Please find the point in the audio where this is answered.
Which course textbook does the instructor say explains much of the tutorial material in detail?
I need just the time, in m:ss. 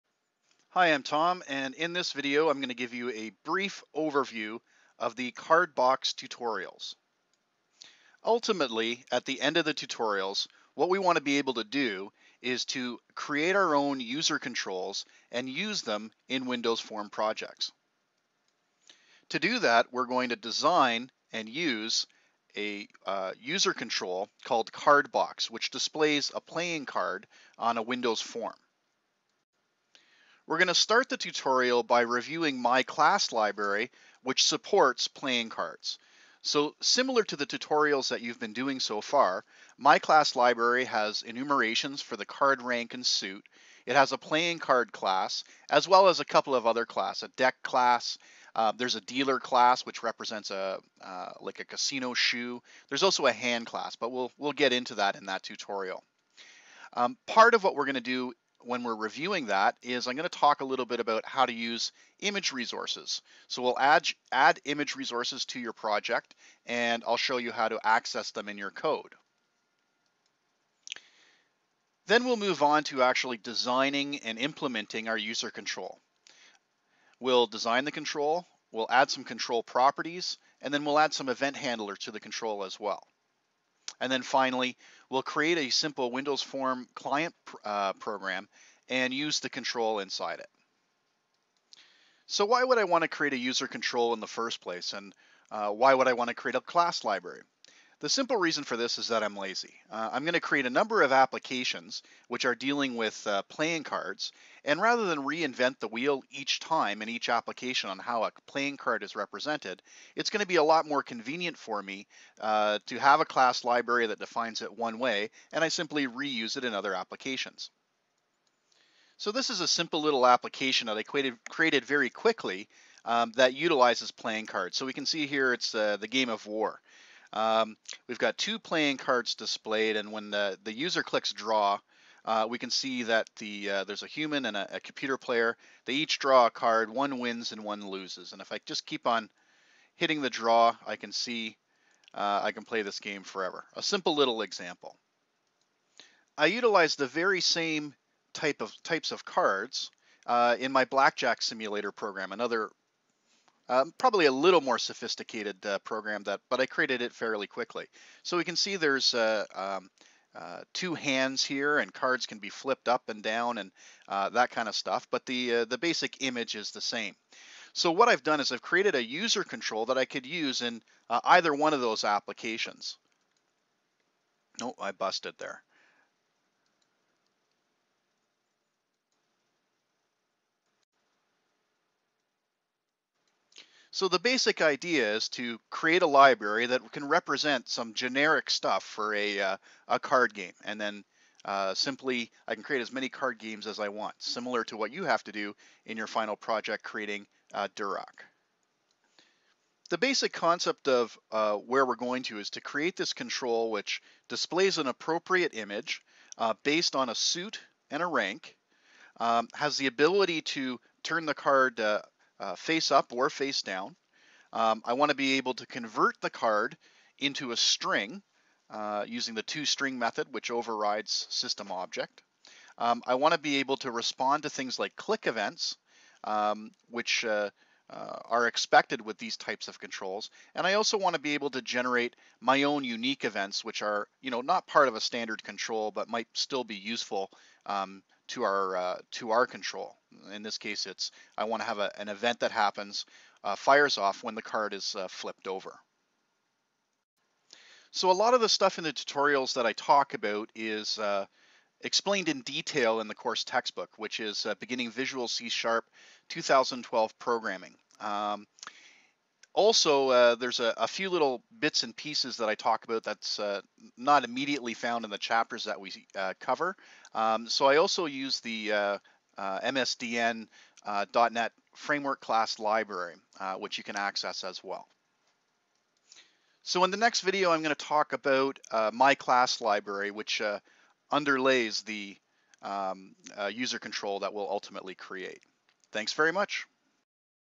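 4:14.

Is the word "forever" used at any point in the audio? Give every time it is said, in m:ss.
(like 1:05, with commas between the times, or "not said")
2:23.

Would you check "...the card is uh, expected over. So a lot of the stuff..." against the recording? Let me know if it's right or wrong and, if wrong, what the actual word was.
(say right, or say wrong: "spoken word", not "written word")
wrong: "flipped", not "expected".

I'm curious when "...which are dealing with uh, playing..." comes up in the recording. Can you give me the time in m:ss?
1:42.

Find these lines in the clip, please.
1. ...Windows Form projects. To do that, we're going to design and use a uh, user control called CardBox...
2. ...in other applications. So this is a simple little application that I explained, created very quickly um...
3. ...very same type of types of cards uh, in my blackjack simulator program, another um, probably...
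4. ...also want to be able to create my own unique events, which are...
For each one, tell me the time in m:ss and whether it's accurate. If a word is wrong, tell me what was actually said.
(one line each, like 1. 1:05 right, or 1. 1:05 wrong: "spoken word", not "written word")
1. 0:16 right
2. 1:56 wrong: "created", not "explained"
3. 2:27 right
4. 3:50 wrong: "generate", not "create".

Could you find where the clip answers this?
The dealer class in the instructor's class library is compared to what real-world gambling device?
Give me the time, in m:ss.
0:51.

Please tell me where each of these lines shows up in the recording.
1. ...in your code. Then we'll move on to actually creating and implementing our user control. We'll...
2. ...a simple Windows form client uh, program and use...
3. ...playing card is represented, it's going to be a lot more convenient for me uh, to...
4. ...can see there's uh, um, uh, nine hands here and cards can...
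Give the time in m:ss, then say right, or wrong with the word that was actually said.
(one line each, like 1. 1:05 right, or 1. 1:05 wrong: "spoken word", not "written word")
1. 1:08 wrong: "designing", not "creating"
2. 1:25 right
3. 1:48 right
4. 2:38 wrong: "two", not "nine".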